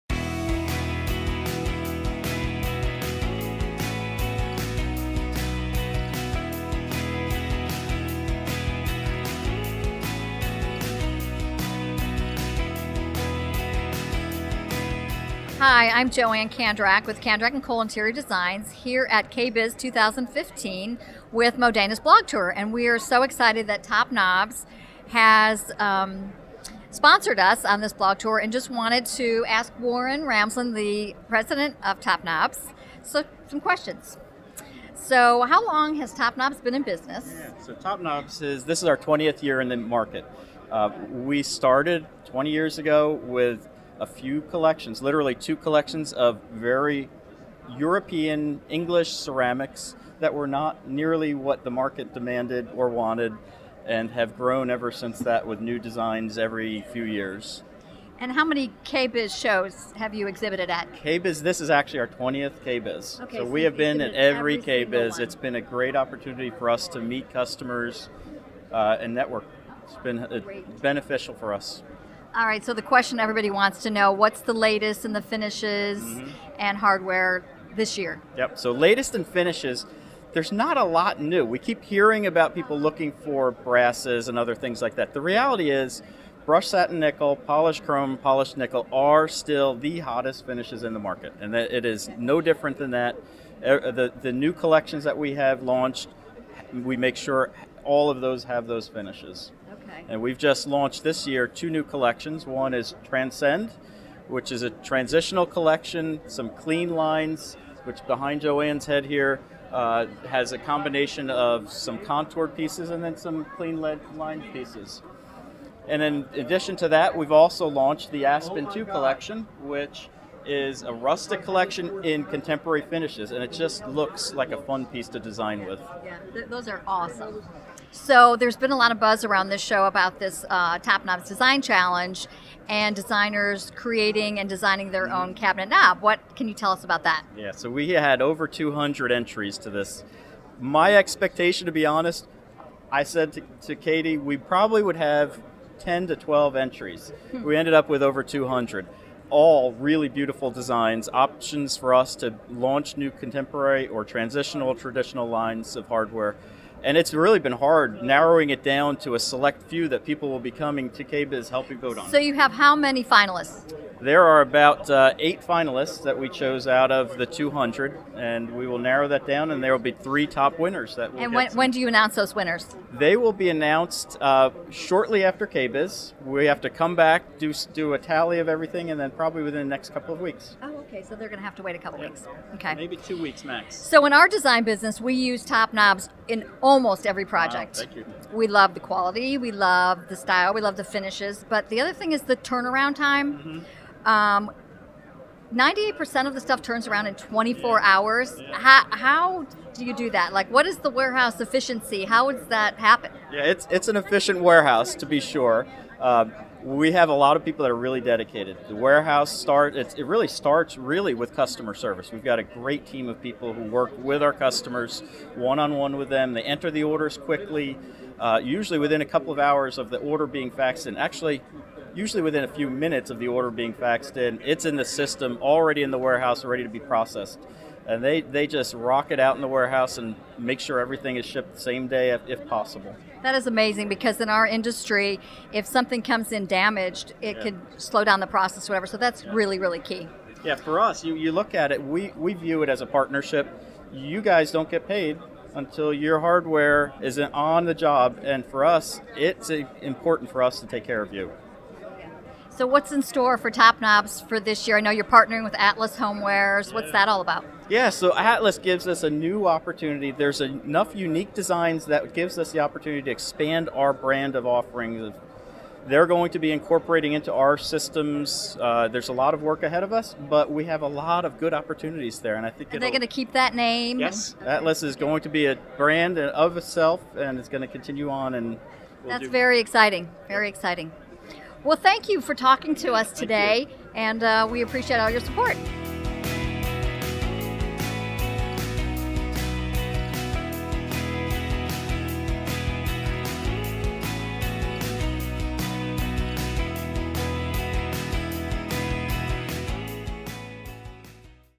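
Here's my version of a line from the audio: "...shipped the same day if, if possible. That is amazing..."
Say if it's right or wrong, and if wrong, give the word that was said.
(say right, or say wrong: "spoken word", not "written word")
right.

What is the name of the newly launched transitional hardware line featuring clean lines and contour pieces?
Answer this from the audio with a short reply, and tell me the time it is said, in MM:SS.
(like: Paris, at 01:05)
Transcend, at 01:43.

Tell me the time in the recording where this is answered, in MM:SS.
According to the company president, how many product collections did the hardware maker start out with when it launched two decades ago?
00:45.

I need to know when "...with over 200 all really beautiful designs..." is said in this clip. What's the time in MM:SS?
02:27.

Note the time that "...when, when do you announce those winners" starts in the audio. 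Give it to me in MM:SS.
02:51.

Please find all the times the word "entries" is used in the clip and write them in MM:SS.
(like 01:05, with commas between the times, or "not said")
02:19, 02:26.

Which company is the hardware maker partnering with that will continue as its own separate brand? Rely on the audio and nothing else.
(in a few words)
Atlas Homewares.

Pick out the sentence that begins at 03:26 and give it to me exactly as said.
Um, we have a lot of people that are really dedicated.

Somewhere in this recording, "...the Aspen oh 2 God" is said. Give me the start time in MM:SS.
01:58.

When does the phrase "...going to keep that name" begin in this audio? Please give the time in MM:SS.
04:32.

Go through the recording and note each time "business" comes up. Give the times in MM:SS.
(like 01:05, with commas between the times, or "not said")
00:36, 03:04.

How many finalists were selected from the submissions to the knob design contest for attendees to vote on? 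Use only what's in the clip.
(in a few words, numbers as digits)
8.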